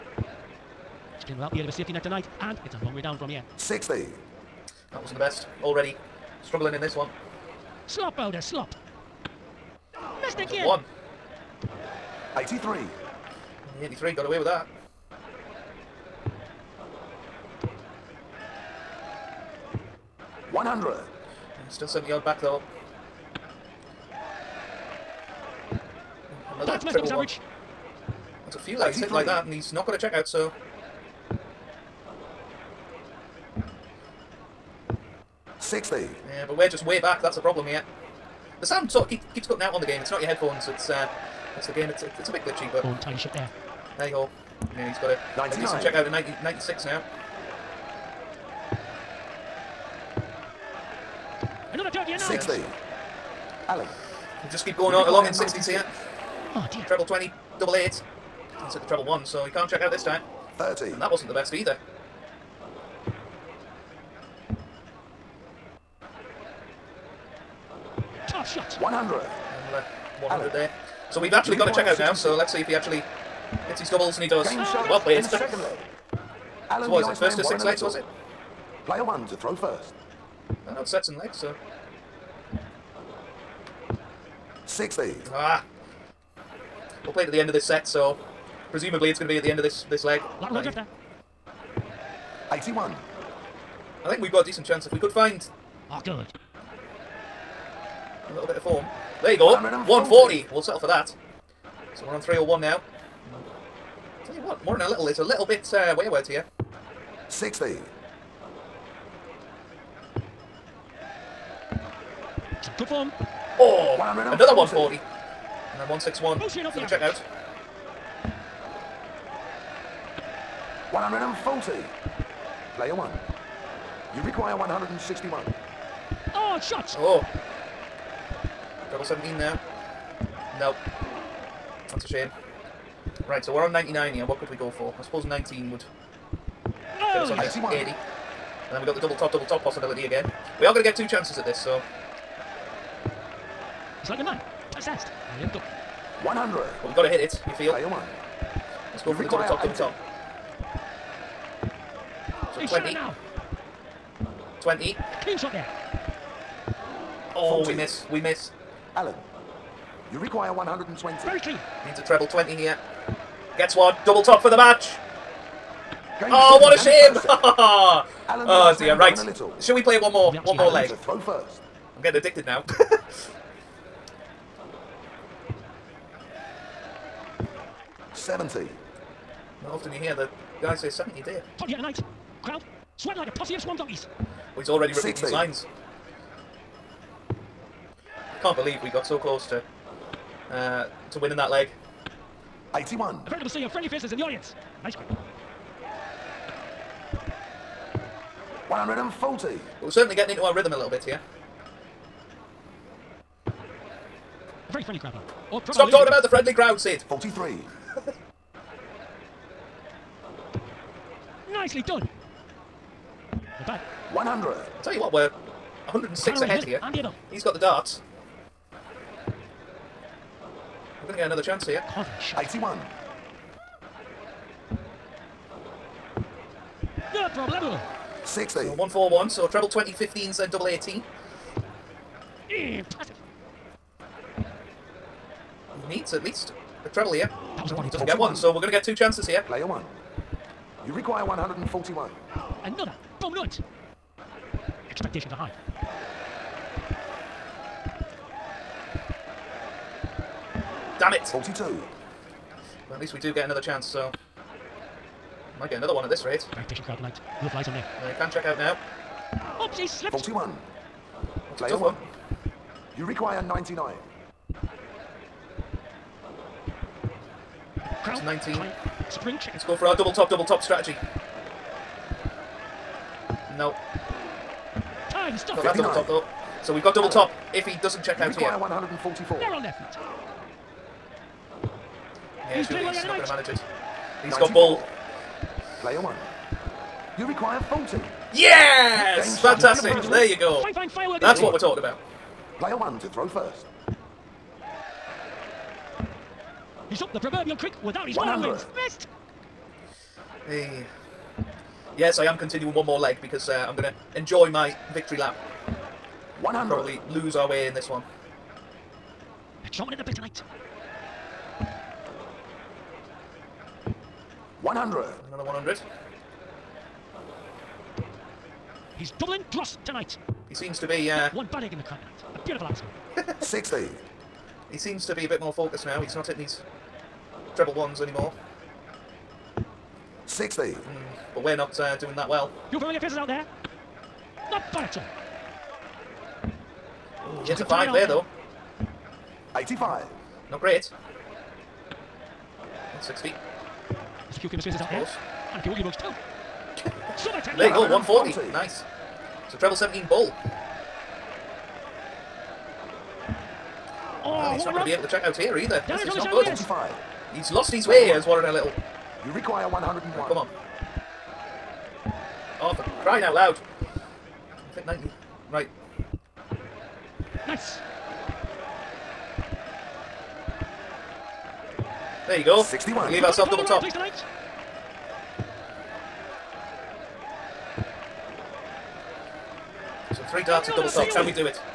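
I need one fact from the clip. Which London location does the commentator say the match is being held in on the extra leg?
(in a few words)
Tottenham.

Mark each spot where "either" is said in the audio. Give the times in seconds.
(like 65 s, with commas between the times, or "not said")
61 s, 355 s.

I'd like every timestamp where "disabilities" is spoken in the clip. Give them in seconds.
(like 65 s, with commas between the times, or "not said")
not said.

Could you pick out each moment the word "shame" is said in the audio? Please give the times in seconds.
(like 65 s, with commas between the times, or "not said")
132 s, 166 s.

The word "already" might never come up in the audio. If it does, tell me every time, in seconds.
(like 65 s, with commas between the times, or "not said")
5 s, 184 s.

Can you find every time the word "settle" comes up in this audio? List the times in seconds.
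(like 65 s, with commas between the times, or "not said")
100 s.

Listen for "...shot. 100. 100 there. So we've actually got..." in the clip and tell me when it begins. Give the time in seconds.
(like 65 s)
68 s.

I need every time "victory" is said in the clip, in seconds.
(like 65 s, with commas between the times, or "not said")
304 s.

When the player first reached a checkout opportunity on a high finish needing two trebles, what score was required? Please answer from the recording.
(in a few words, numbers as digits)
161.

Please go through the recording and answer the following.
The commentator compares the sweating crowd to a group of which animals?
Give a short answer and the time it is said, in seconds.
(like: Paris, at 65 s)
Donkeys, at 183 s.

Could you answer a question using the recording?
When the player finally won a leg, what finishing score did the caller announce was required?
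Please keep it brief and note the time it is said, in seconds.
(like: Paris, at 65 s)
40, at 287 s.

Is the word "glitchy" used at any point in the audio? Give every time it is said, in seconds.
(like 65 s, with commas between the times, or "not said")
42 s.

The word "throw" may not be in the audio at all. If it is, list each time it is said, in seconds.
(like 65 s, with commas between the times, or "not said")
79 s, 171 s, 293 s.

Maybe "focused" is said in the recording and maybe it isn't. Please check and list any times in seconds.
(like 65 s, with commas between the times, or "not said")
325 s.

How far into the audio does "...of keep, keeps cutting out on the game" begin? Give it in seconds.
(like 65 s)
39 s.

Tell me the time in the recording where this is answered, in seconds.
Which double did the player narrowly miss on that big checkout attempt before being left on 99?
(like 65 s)
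128 s.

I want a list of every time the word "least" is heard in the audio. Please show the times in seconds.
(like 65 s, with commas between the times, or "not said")
236 s, 252 s.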